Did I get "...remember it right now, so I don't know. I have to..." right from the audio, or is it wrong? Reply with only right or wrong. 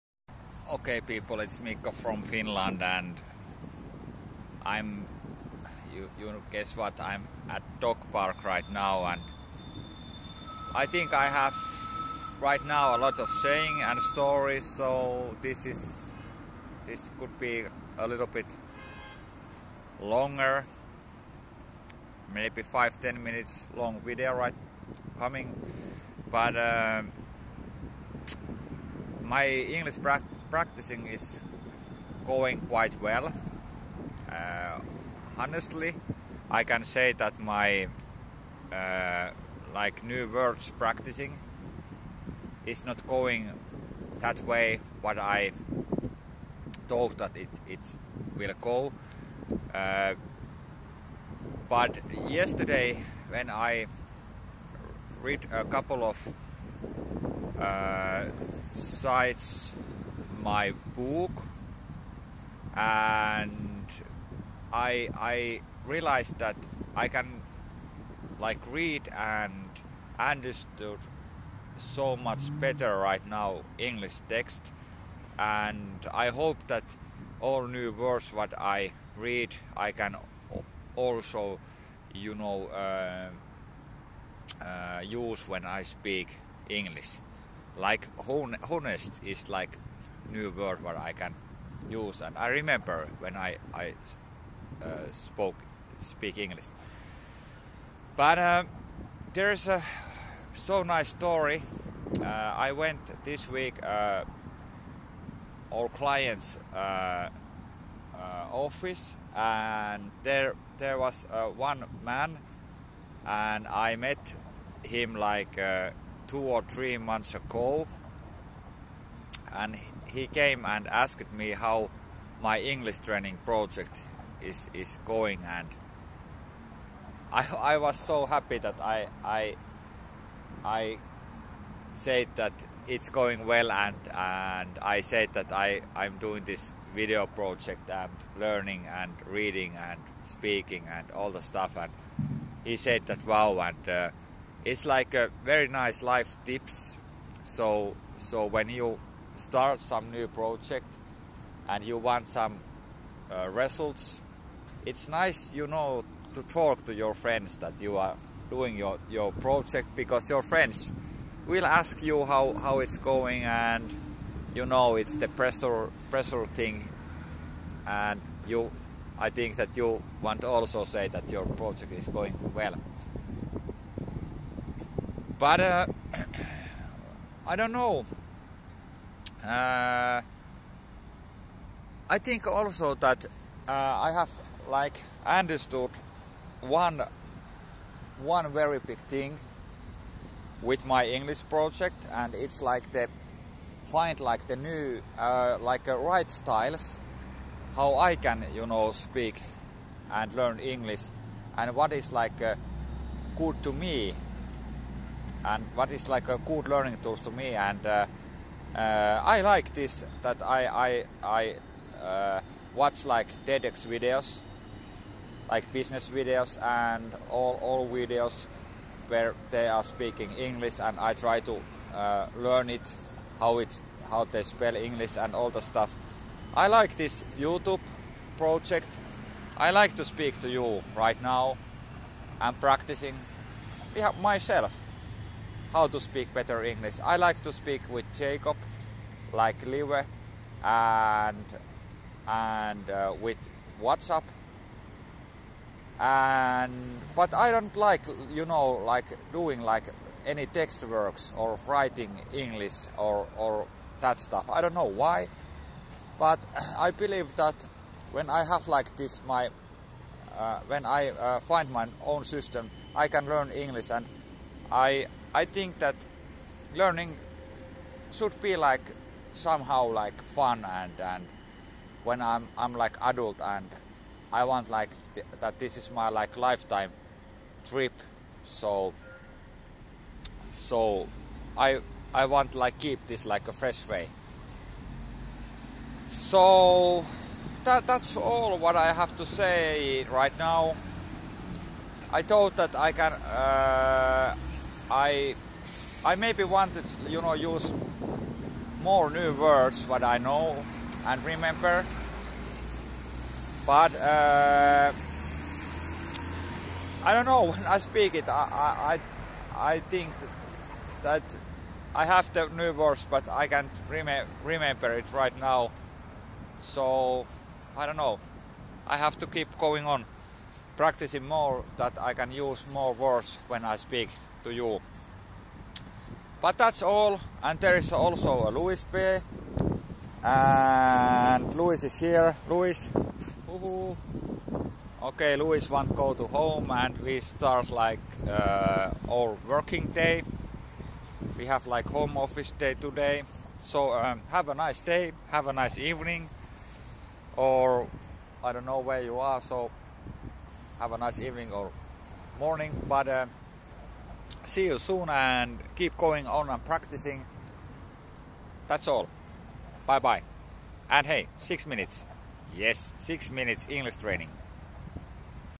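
right.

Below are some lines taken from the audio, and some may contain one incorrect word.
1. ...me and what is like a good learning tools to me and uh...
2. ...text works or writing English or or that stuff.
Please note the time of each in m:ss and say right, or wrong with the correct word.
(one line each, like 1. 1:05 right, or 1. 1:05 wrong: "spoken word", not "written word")
1. 3:23 right
2. 4:10 right.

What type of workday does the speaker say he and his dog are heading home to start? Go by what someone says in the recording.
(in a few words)
home office day.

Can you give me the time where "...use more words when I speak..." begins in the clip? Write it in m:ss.
5:22.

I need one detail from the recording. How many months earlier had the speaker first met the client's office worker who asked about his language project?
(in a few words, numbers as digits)
2 or 3.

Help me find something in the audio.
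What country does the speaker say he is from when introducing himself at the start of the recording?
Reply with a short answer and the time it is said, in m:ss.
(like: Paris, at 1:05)
Finland, at 0:02.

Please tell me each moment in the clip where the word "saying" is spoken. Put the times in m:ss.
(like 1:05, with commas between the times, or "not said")
0:13.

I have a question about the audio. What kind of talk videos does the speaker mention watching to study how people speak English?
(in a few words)
TEDx.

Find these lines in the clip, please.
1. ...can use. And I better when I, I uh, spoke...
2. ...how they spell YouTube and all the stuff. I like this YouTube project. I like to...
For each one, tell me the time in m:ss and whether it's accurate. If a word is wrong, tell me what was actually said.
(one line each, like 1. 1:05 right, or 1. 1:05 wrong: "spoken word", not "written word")
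1. 1:31 wrong: "remember", not "better"
2. 3:44 wrong: "English", not "YouTube".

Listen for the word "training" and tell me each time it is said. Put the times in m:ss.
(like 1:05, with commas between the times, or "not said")
2:02, 6:03.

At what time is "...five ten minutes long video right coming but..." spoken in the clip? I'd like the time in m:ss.
0:22.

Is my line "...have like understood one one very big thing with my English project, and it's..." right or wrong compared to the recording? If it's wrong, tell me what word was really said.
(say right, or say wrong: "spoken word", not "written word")
right.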